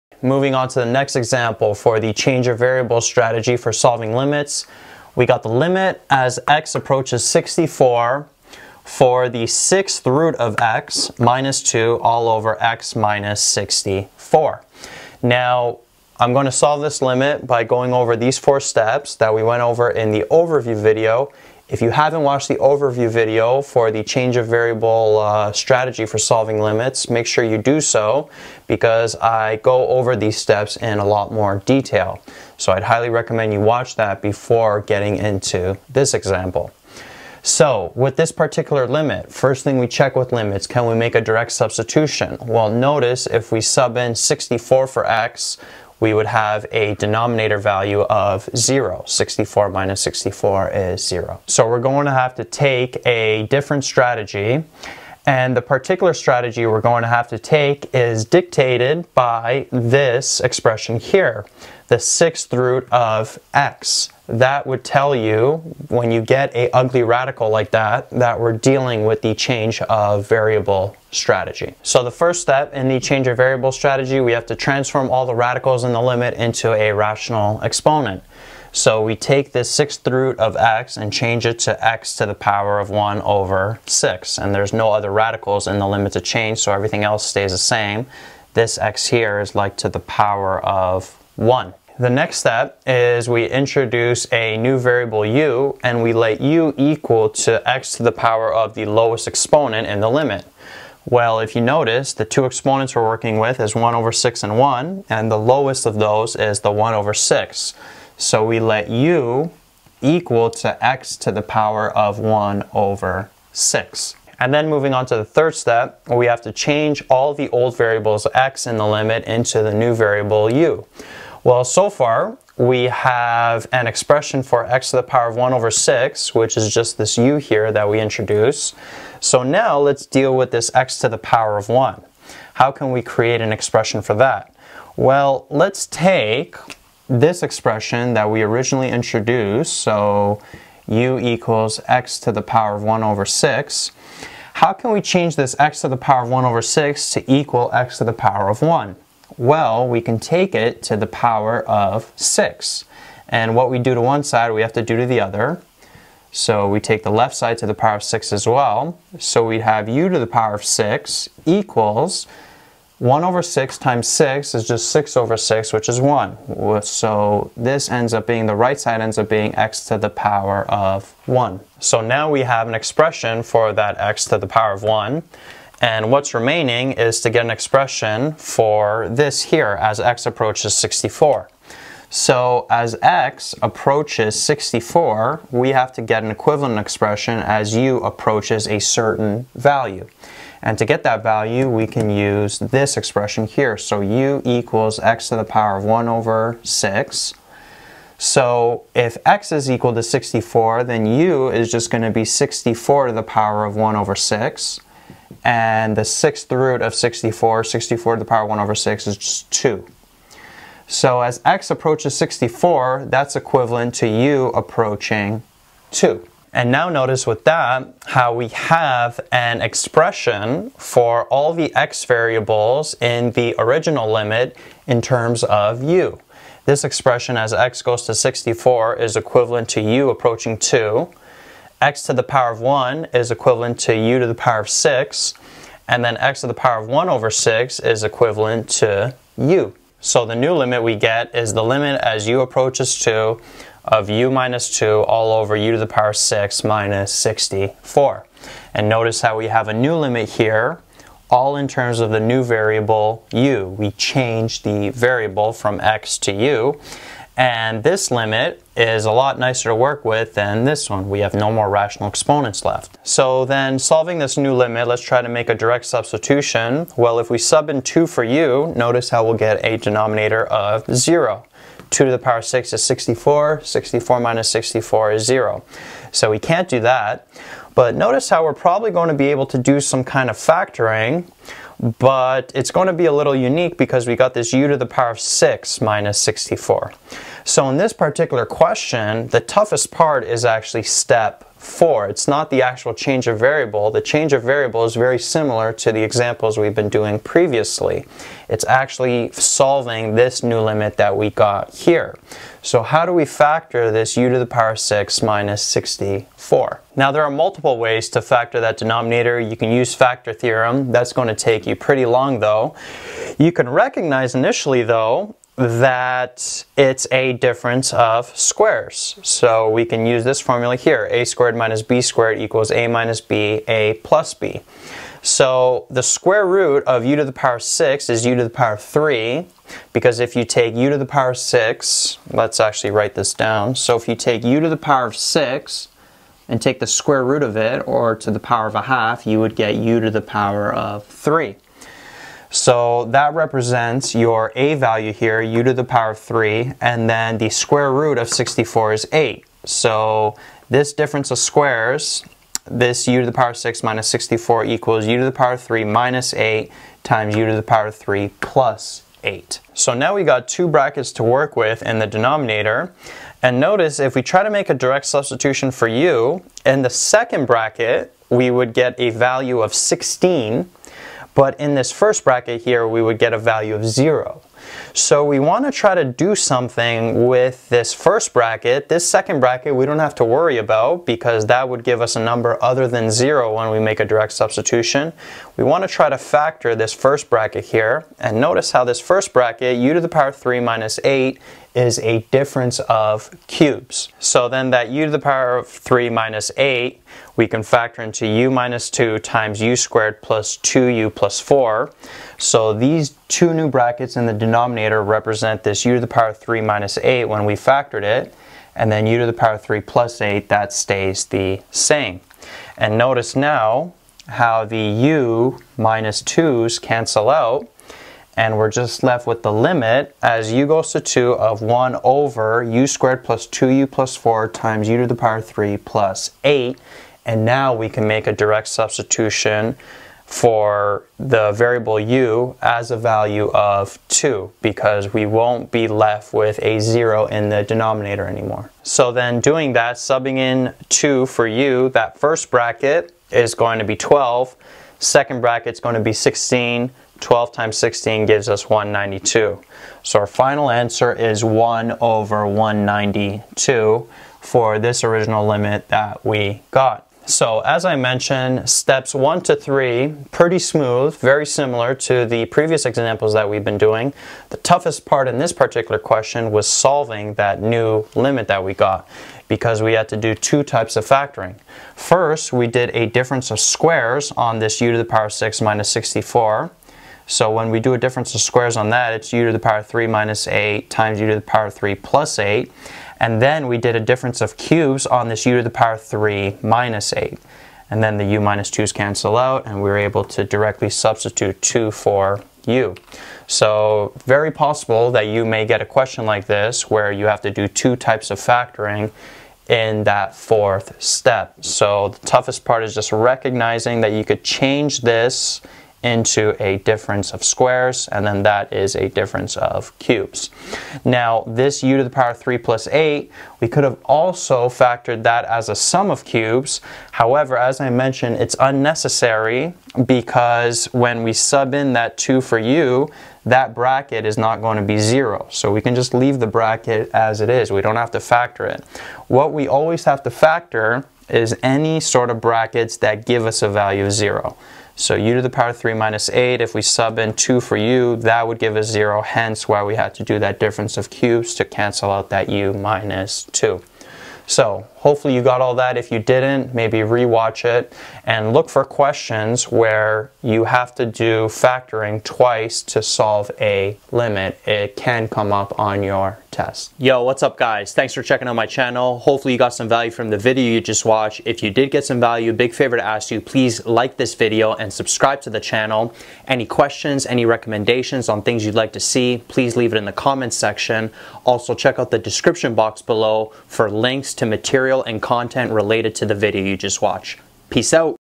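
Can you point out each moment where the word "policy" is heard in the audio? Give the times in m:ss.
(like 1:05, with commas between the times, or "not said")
not said.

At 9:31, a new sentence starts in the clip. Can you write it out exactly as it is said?
Also check out the description box below for links to material and content related to the video you just watched.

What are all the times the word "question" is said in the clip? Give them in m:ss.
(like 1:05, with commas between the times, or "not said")
4:48, 7:45, 8:15, 9:08, 9:26.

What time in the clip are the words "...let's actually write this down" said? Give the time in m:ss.
5:32.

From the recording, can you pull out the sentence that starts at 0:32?
So I'd highly recommend you watch that before getting into this example.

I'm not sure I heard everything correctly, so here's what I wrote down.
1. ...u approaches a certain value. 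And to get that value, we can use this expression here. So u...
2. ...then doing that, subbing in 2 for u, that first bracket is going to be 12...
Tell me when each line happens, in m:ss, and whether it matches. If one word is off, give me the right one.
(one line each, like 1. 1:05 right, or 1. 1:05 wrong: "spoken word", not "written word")
1. 3:07 right
2. 7:19 right.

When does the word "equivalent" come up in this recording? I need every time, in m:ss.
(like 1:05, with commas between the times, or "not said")
3:06, 3:33, 3:49, 3:53, 3:58.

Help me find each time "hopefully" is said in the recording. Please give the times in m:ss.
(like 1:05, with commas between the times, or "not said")
9:04, 9:19.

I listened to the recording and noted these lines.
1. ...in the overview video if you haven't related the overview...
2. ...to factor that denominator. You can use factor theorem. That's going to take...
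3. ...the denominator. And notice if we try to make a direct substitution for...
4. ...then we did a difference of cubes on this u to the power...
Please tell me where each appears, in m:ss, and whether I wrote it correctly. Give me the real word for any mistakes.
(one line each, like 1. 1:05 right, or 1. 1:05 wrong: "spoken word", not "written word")
1. 0:19 wrong: "watched", not "related"
2. 5:08 right
3. 6:01 right
4. 8:03 right.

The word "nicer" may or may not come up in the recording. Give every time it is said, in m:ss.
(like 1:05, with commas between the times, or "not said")
4:19.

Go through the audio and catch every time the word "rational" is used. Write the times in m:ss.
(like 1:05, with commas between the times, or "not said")
1:16, 4:21.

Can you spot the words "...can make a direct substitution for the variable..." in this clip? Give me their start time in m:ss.
7:07.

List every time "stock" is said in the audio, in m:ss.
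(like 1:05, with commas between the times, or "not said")
not said.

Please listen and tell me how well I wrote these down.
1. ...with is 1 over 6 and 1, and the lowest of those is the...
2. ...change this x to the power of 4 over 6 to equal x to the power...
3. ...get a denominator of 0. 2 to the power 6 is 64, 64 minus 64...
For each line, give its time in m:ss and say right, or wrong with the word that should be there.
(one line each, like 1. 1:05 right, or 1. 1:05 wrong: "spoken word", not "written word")
1. 1:43 right
2. 2:25 wrong: "1", not "4"
3. 4:29 right.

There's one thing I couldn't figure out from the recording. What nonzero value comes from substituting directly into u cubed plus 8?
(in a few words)
16.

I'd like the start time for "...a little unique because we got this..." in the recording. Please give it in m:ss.
4:43.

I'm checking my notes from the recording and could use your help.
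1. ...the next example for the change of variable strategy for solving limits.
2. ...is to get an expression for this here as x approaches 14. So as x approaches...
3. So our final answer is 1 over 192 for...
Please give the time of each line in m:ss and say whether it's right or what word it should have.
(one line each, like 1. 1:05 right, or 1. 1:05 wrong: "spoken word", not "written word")
1. 0:00 right
2. 2:56 wrong: "64", not "14"
3. 7:30 right.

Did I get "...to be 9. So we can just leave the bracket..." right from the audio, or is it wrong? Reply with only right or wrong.
wrong.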